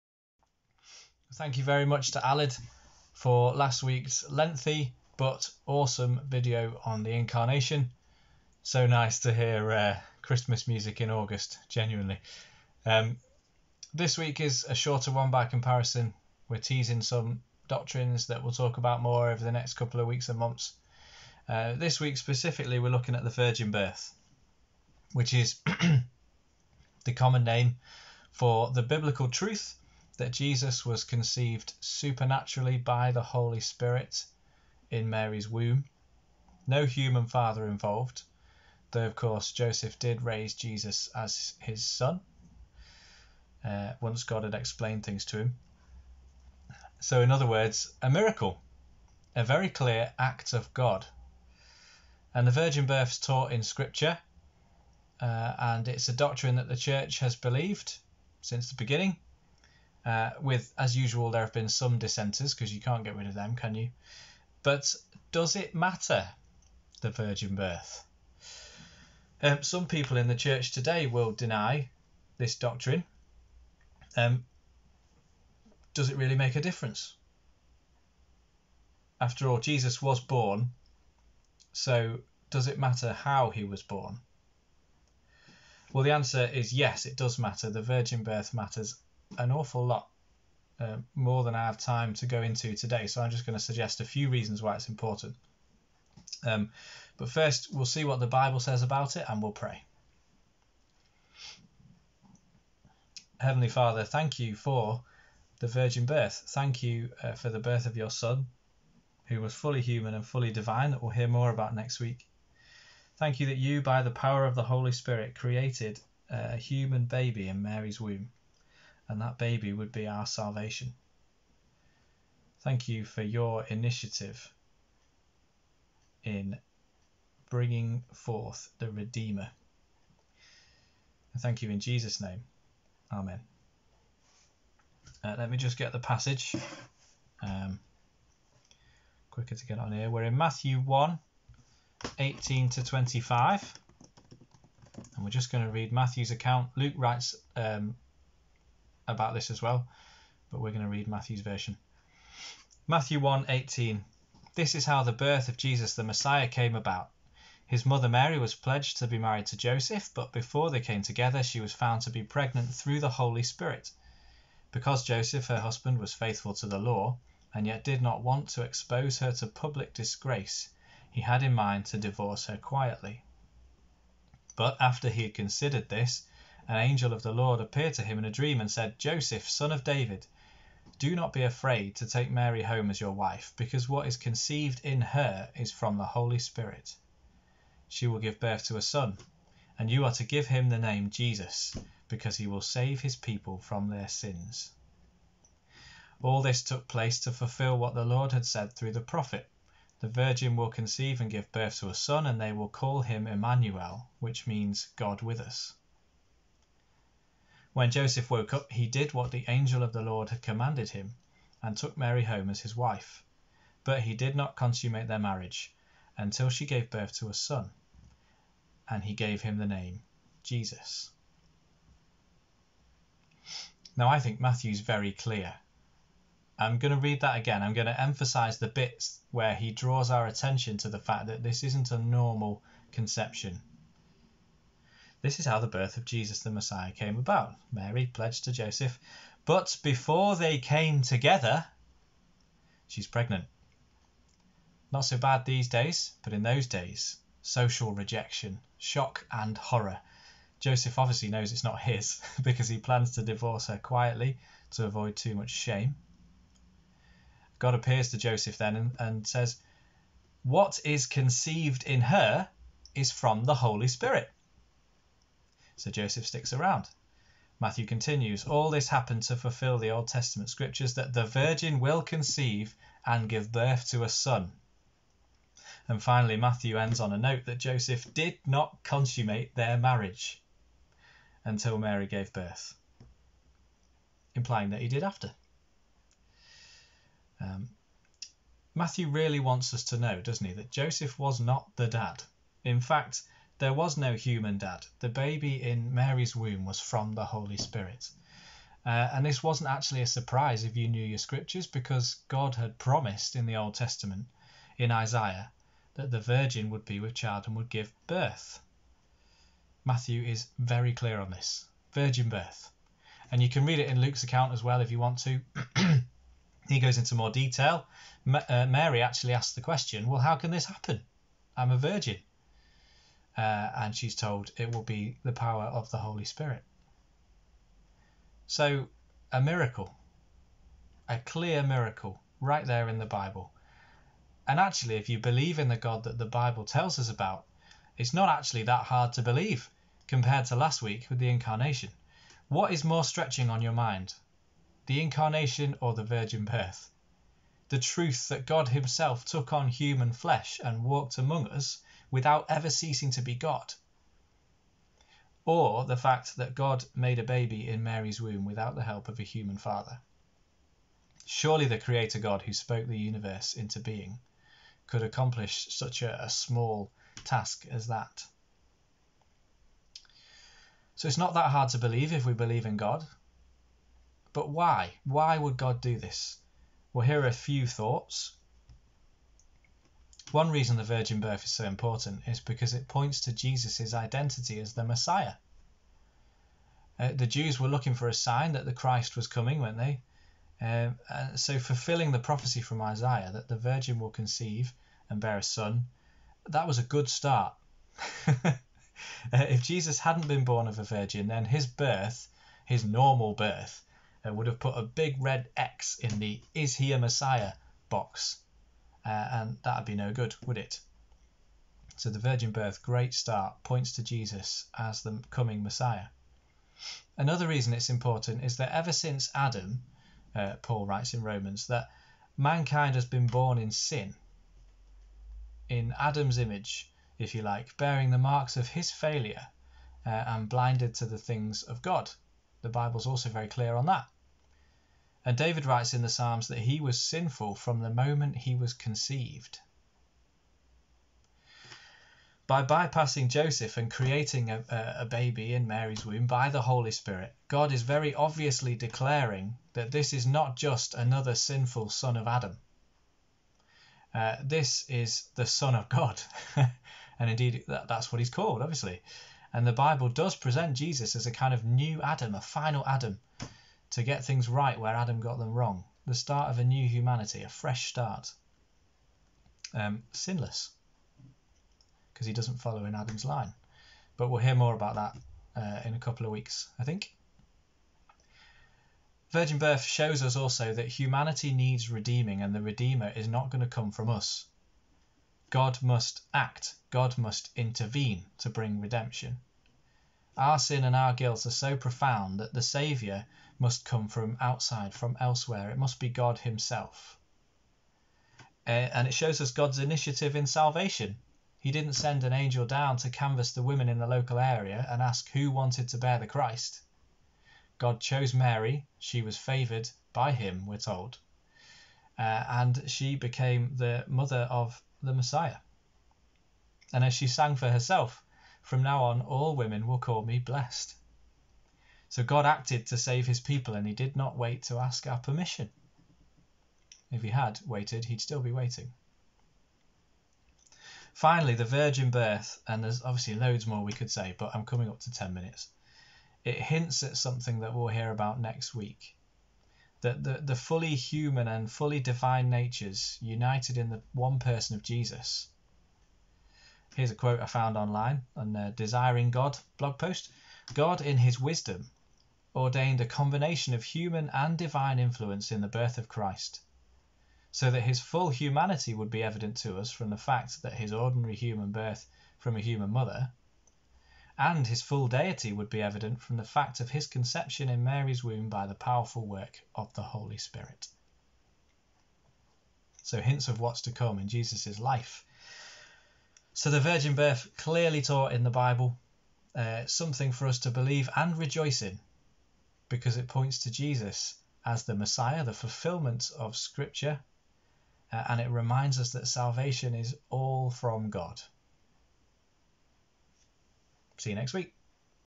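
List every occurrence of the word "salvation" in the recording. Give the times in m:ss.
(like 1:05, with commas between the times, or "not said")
2:00, 8:20, 9:49.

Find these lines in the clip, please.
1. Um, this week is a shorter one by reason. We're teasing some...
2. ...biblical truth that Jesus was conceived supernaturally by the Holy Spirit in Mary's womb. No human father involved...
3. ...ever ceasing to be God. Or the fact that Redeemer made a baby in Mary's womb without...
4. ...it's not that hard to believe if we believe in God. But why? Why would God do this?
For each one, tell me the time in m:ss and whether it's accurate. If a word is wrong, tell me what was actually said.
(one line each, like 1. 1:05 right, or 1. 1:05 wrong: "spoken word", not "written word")
1. 0:12 wrong: "comparison", not "reason"
2. 0:28 right
3. 5:52 wrong: "God", not "Redeemer"
4. 6:11 right.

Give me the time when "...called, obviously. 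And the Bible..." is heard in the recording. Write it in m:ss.
7:38.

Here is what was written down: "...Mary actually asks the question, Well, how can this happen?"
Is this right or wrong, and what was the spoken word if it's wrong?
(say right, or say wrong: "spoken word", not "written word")
right.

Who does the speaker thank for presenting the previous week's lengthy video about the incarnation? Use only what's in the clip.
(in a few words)
Alid.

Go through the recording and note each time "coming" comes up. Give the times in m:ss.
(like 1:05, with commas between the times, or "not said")
6:29, 6:55, 8:54.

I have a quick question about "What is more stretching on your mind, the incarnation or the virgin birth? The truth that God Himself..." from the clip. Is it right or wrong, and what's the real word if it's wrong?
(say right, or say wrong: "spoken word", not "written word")
right.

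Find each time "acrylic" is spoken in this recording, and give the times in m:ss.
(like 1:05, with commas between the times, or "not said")
not said.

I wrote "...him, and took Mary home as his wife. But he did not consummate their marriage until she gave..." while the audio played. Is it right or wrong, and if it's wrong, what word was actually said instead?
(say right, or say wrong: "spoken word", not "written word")
right.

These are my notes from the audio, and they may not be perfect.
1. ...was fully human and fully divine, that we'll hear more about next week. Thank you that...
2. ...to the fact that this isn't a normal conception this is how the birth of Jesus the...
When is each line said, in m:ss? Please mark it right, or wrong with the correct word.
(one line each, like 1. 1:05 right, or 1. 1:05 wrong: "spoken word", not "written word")
1. 1:49 right
2. 3:50 right.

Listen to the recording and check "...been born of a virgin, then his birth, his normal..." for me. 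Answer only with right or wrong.
right.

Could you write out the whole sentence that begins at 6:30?
Um, uh, so, fulfilling the prophecy from Isaiah that the virgin will conceive and bear a son, that was a good start.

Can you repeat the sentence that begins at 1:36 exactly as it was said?
Um, but first, we'll see what the Bible says about it and we'll pray.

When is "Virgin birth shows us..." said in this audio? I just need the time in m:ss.
7:59.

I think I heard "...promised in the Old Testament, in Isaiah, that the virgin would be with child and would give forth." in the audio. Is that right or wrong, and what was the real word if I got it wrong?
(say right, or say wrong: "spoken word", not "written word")
wrong: "birth", not "forth".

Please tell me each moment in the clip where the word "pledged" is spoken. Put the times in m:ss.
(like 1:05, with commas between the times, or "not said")
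2:38, 3:58.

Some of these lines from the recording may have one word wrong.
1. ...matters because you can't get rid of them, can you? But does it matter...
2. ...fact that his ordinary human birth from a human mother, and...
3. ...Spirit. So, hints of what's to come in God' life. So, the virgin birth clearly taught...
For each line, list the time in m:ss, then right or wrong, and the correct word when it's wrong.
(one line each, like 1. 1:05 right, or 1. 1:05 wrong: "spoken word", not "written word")
1. 1:01 wrong: "dissenters", not "matters"
2. 9:20 right
3. 9:30 wrong: "Jesus", not "God".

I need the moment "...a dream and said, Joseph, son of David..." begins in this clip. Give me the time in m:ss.
2:58.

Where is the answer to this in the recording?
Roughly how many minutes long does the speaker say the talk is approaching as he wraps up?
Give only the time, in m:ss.
8:55.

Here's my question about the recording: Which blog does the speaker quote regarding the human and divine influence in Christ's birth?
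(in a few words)
Desiring God.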